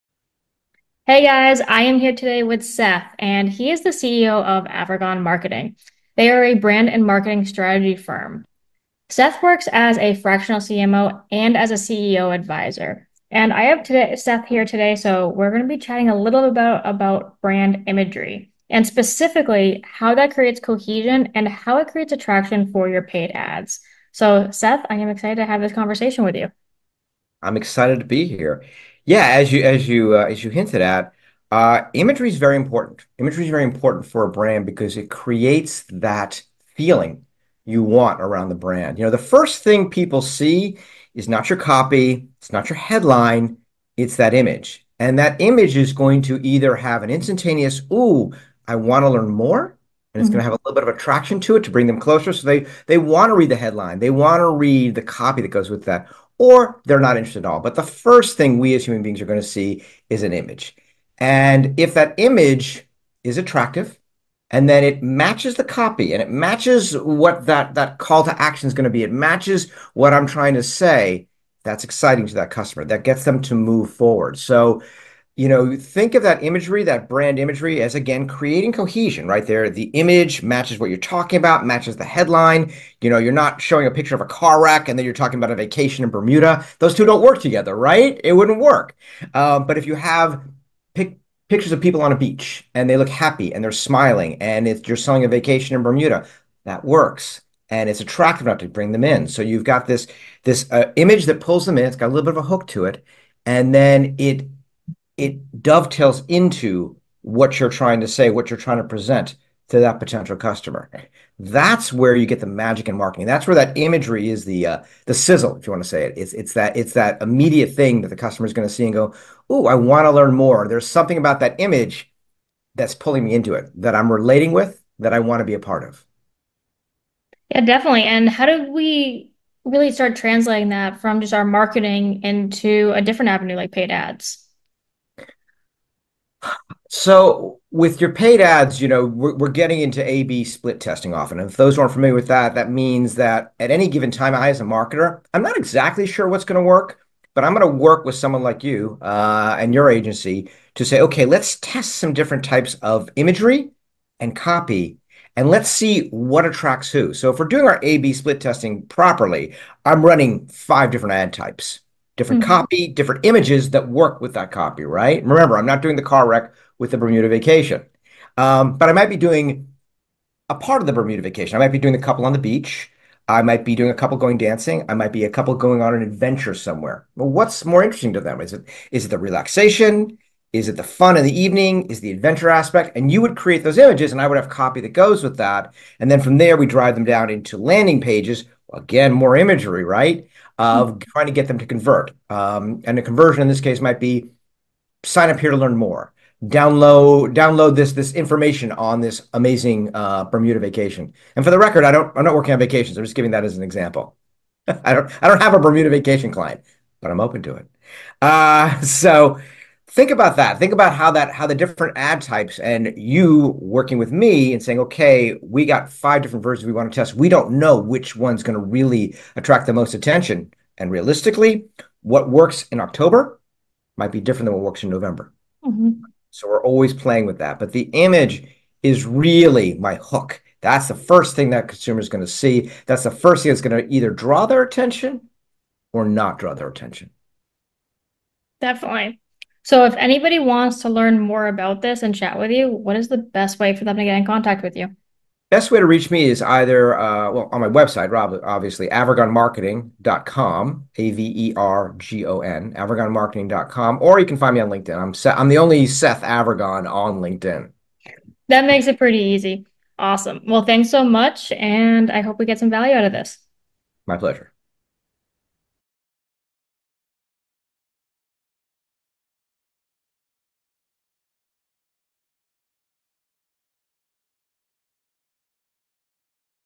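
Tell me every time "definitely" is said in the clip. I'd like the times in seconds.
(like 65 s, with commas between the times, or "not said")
127 s, 238 s.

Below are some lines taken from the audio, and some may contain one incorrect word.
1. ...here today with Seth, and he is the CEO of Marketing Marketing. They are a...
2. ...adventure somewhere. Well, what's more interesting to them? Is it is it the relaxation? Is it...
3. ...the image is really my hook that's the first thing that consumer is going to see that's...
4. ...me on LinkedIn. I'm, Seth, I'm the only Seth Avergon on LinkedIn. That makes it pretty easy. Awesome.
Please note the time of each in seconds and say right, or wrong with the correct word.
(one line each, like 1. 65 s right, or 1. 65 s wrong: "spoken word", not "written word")
1. 1 s wrong: "Avergon", not "Marketing"
2. 176 s right
3. 227 s right
4. 254 s right.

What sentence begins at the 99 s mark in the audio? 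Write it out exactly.
So you've got this this uh, image that pulls them in.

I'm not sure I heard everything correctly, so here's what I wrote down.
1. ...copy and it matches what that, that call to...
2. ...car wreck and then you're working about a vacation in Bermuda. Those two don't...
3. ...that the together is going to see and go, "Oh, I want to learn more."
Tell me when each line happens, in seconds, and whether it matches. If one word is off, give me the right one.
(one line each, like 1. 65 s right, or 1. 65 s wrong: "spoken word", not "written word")
1. 65 s right
2. 84 s wrong: "talking", not "working"
3. 118 s wrong: "customer", not "together".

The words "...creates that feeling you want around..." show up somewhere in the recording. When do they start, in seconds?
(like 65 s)
35 s.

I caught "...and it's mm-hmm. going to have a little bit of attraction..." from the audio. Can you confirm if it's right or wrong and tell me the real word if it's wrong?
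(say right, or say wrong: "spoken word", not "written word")
right.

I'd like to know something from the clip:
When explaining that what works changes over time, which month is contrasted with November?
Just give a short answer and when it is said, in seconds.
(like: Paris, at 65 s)
October, at 222 s.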